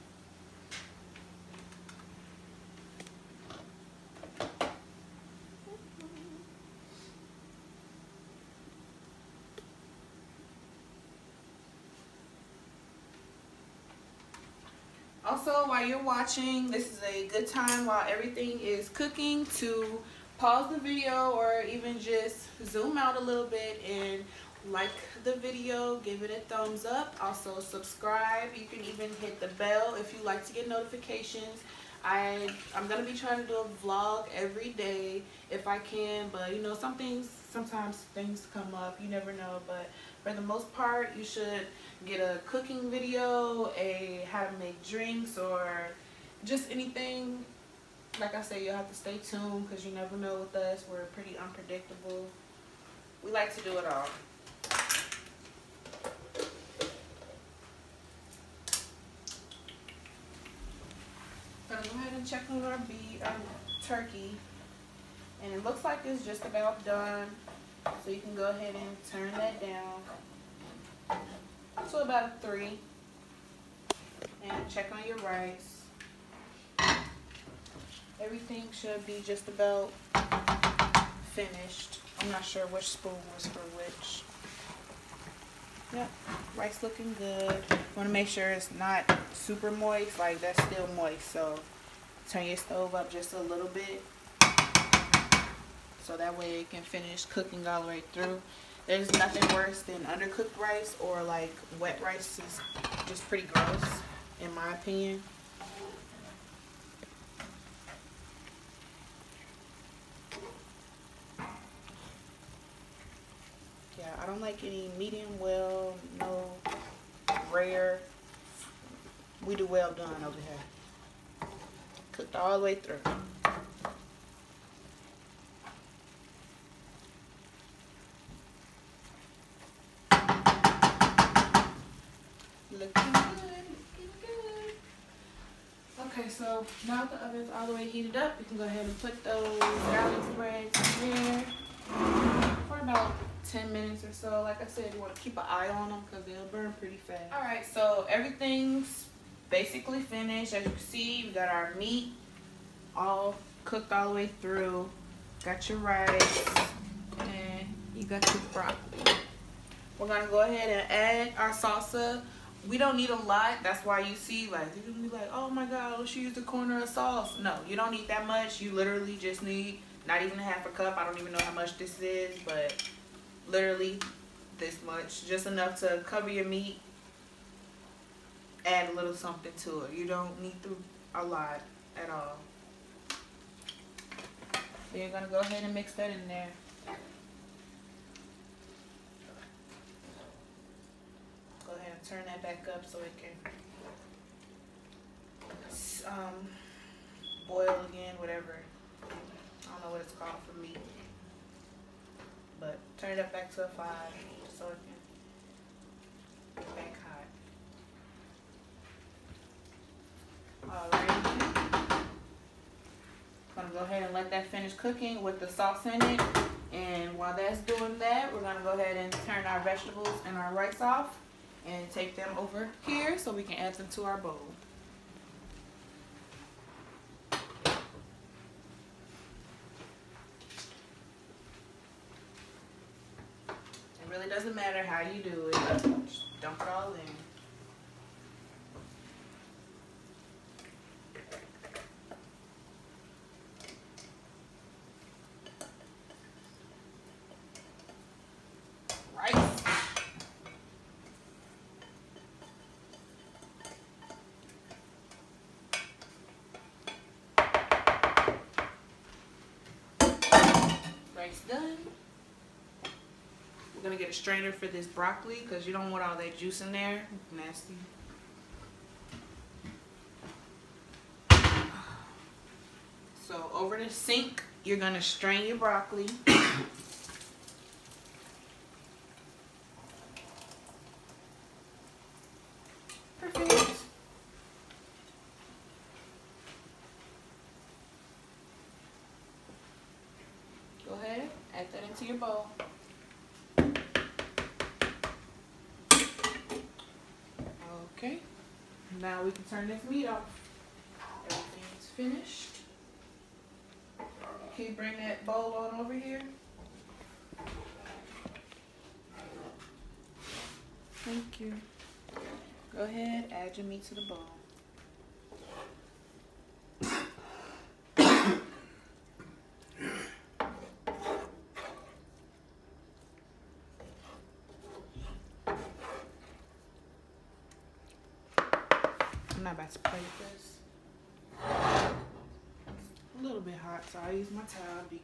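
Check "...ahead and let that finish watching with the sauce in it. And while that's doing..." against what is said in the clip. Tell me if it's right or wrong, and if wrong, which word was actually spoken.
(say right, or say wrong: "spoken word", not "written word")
wrong: "cooking", not "watching".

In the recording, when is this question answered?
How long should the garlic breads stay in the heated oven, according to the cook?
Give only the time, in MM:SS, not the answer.
02:22.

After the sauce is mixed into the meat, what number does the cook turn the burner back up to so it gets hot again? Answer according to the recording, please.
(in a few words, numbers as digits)
5.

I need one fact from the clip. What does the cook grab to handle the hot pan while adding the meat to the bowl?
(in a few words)
towel.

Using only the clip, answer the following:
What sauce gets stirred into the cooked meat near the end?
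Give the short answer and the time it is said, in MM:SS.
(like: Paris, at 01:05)
salsa, at 02:41.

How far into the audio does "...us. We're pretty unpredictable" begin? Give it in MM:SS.
00:50.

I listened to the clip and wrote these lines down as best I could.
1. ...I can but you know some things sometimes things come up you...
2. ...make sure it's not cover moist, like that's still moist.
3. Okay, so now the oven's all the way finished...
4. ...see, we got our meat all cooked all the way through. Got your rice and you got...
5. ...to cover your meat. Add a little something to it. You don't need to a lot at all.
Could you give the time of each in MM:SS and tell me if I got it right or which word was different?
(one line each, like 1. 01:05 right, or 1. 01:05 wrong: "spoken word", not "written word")
1. 00:35 right
2. 01:28 wrong: "super", not "cover"
3. 02:16 wrong: "heated", not "finished"
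4. 02:30 right
5. 02:55 right.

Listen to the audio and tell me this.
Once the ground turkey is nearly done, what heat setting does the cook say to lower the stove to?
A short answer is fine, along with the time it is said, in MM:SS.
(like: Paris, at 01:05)
3, at 01:11.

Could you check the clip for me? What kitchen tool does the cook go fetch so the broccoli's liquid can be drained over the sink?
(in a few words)
strainer.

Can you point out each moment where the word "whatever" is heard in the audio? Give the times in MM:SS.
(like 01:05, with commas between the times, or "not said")
03:18.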